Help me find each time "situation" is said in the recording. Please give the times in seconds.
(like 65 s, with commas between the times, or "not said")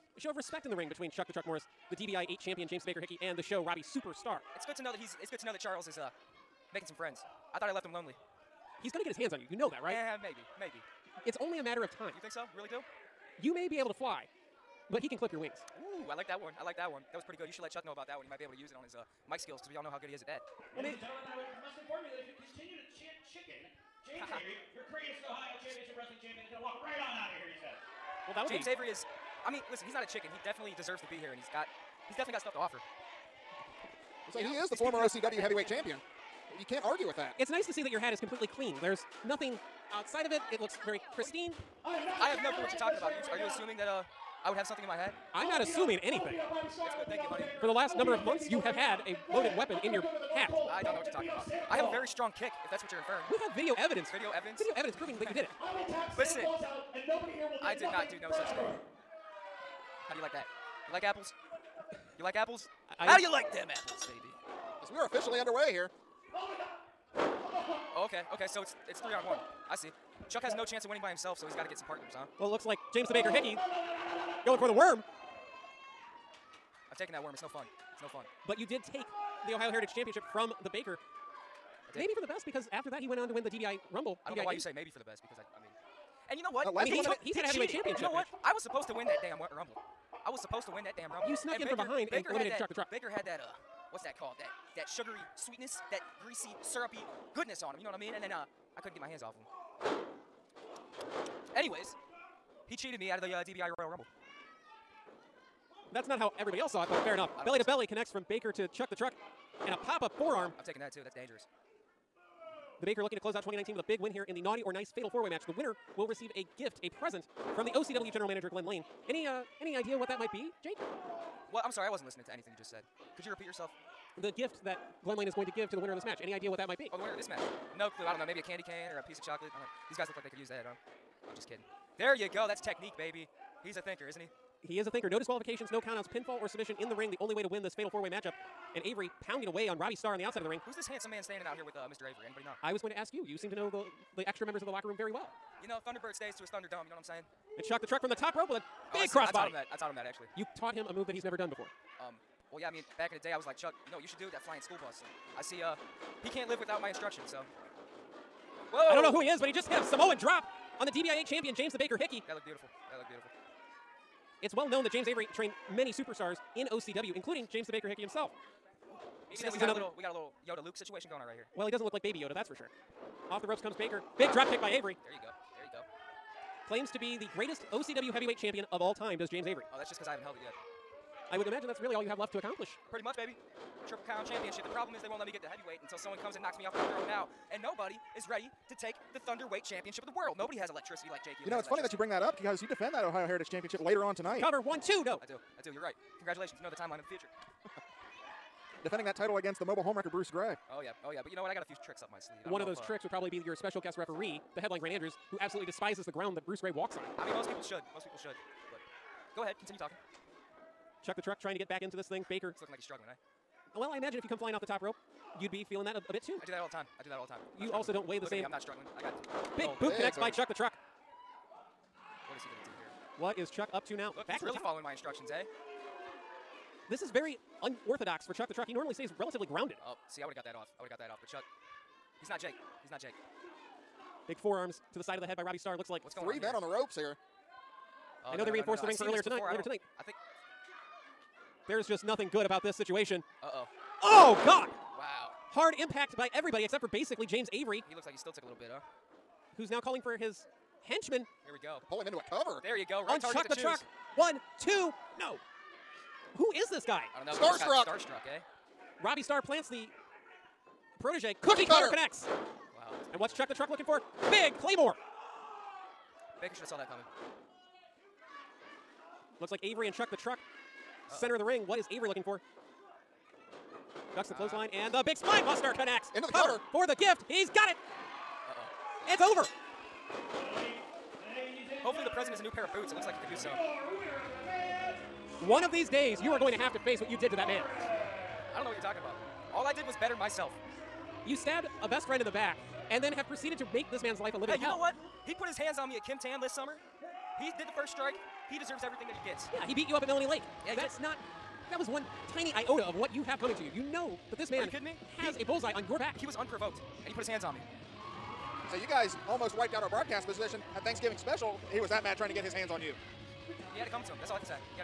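170 s, 242 s.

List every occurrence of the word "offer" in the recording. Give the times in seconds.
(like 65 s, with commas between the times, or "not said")
32 s.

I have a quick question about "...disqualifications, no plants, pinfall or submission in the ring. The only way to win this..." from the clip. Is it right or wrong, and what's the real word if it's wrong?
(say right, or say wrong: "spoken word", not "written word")
wrong: "countouts", not "plants".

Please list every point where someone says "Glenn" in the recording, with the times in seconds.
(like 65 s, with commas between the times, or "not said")
118 s, 125 s.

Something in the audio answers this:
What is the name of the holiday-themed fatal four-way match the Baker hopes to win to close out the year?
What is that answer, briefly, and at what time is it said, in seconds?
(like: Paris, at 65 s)
Naughty or Nice, at 114 s.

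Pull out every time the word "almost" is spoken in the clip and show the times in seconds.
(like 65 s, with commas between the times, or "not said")
309 s.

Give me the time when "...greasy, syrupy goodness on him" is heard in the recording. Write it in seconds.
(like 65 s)
96 s.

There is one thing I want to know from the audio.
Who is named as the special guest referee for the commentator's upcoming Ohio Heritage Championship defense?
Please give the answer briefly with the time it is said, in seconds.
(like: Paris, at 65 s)
Grant Andrews, at 204 s.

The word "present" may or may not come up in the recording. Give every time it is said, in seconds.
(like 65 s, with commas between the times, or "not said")
116 s, 282 s.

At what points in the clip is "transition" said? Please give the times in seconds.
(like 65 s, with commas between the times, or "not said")
not said.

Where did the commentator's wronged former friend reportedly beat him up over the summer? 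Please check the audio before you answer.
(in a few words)
Melanie Lake.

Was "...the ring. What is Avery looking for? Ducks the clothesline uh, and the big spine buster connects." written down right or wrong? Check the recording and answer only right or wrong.
right.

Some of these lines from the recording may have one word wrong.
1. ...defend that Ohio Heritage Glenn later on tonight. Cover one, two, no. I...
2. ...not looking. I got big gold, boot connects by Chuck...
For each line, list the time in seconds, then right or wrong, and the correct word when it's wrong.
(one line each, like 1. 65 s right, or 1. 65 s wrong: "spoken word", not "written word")
1. 192 s wrong: "Championship", not "Glenn"
2. 218 s wrong: "struggling", not "looking".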